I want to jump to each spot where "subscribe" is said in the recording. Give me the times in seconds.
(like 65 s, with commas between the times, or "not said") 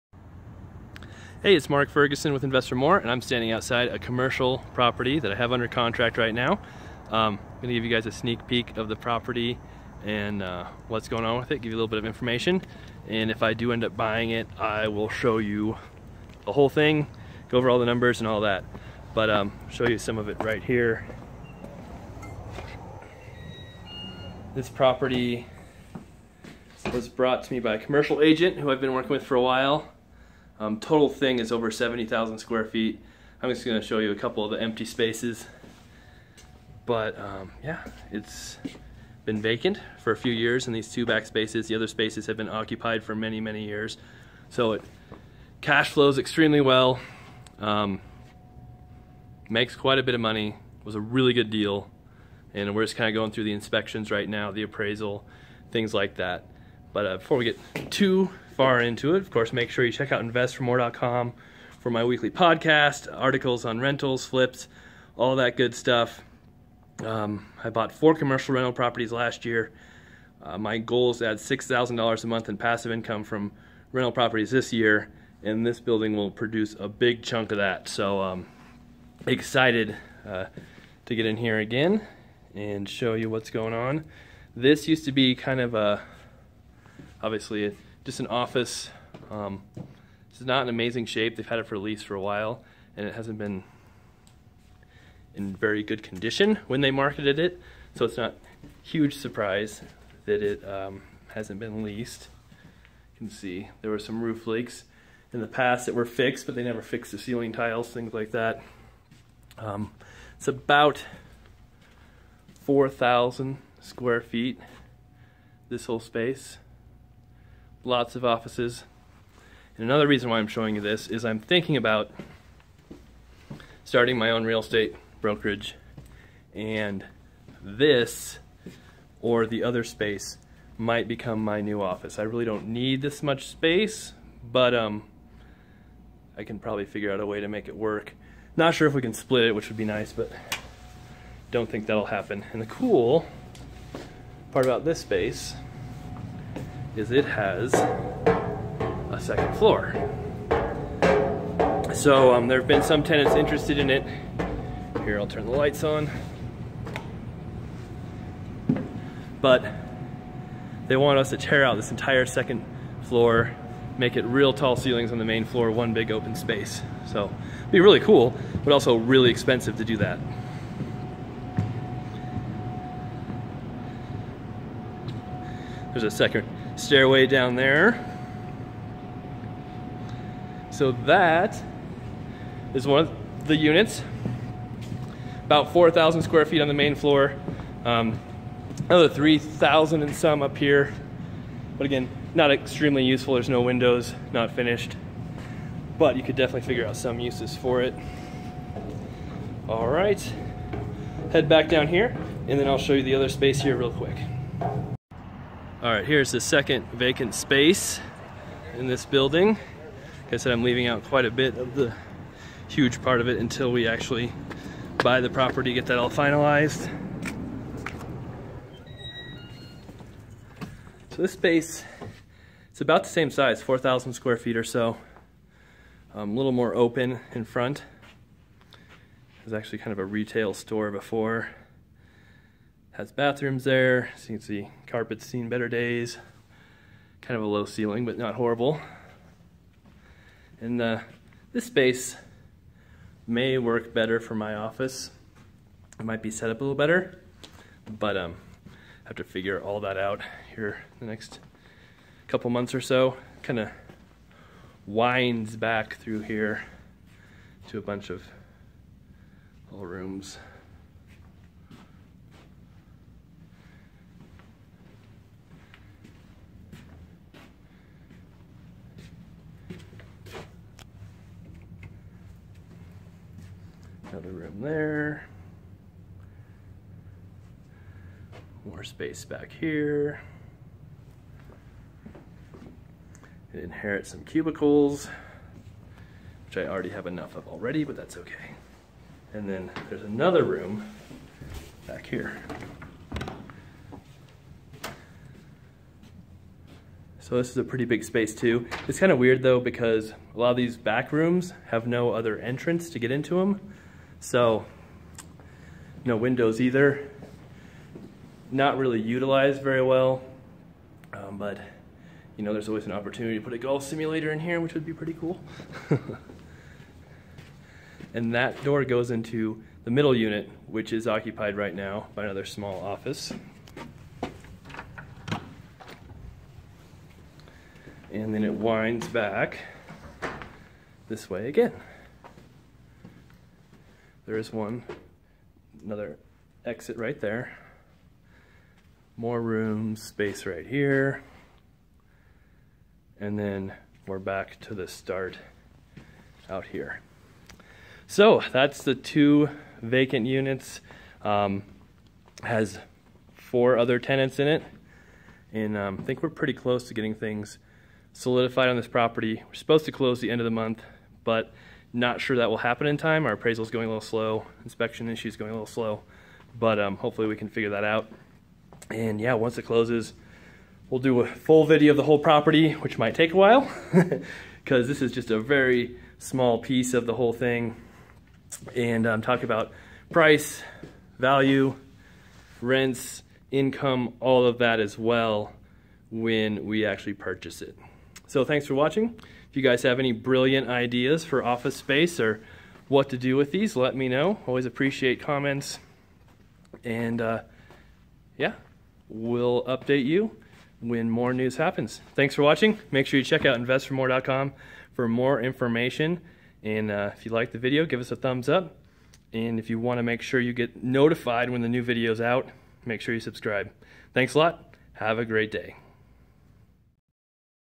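413 s.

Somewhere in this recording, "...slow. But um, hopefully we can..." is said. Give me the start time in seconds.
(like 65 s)
365 s.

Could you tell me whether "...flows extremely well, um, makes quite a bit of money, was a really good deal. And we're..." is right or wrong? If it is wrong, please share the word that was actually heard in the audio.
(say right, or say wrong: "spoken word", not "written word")
right.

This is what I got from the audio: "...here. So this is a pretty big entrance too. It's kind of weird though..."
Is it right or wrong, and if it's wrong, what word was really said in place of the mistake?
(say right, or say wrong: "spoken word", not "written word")
wrong: "space", not "entrance".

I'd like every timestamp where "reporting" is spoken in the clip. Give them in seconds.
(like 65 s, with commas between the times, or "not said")
not said.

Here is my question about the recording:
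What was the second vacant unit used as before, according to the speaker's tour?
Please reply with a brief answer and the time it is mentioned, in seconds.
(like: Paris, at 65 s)
retail store, at 230 s.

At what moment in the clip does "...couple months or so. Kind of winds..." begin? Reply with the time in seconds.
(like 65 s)
252 s.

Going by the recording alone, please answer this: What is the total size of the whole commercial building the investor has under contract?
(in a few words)
over 70,000 square feet.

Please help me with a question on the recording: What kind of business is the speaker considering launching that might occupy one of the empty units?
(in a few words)
real estate brokerage.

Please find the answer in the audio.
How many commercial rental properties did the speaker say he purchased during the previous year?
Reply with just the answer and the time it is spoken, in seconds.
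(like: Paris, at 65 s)
4, at 67 s.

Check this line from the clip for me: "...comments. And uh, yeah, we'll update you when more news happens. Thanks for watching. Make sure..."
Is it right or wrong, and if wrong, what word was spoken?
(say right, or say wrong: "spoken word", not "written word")
right.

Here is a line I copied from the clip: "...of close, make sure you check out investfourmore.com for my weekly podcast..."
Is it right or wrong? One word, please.
wrong.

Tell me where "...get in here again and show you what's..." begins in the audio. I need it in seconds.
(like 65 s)
81 s.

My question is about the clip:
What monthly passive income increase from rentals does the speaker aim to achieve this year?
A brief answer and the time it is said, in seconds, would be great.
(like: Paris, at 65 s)
$6,000, at 71 s.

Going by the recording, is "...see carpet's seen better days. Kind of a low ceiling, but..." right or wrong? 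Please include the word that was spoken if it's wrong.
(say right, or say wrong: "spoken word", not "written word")
right.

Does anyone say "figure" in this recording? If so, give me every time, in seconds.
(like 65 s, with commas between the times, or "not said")
136 s, 196 s, 249 s, 367 s.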